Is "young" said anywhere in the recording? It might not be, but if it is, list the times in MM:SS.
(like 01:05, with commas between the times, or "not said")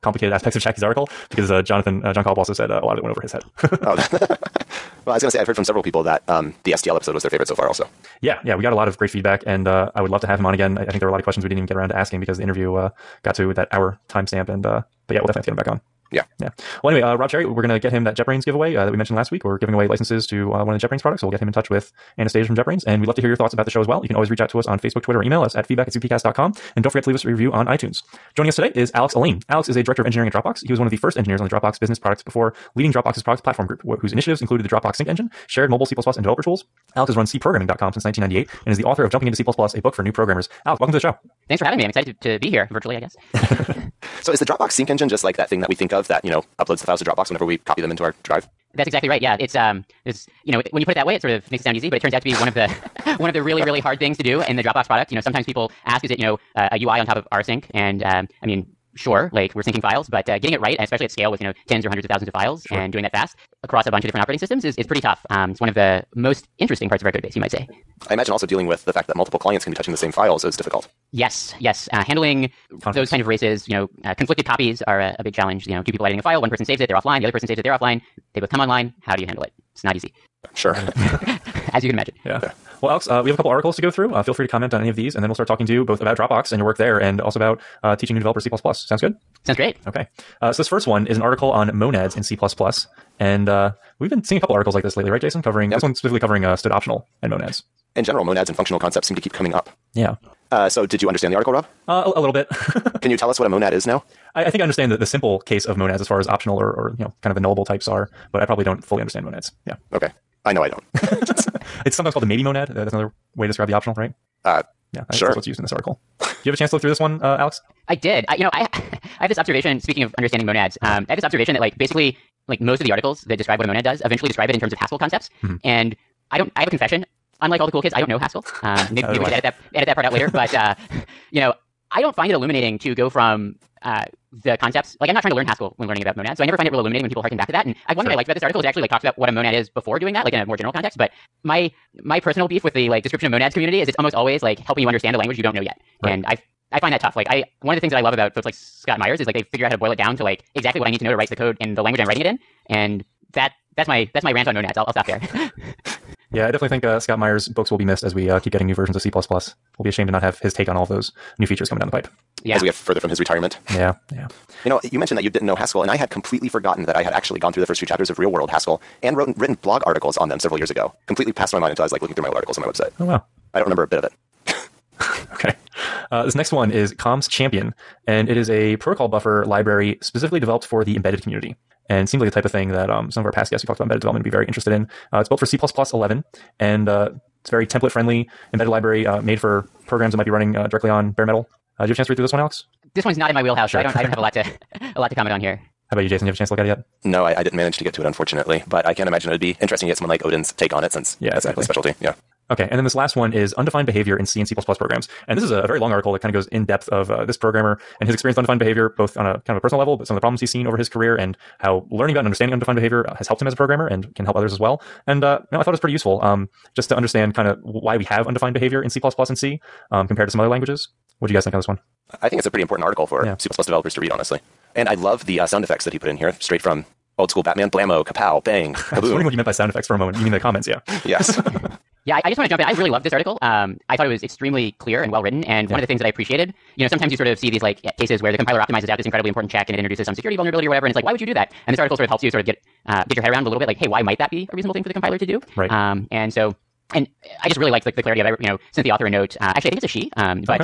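not said.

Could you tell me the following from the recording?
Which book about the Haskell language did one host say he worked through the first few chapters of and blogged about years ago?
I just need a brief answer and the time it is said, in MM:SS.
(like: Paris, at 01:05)
Real World Haskell, at 02:48.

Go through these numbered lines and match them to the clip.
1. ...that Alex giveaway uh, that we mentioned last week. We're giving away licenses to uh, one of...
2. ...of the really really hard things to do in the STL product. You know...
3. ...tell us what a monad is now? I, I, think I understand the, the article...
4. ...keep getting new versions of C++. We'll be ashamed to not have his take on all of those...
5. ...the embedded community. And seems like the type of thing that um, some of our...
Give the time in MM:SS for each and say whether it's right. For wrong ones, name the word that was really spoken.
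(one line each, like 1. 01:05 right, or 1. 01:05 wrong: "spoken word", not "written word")
1. 00:18 wrong: "JetBrains", not "Alex"
2. 00:53 wrong: "Dropbox", not "STL"
3. 01:43 wrong: "simple", not "article"
4. 02:38 right
5. 03:00 right.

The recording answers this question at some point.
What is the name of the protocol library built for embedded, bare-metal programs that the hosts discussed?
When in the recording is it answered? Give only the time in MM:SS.
02:56.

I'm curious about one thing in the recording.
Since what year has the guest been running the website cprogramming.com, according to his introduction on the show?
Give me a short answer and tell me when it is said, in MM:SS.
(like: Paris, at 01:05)
1998, at 00:38.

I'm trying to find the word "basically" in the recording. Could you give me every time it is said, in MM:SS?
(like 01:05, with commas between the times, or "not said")
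02:01.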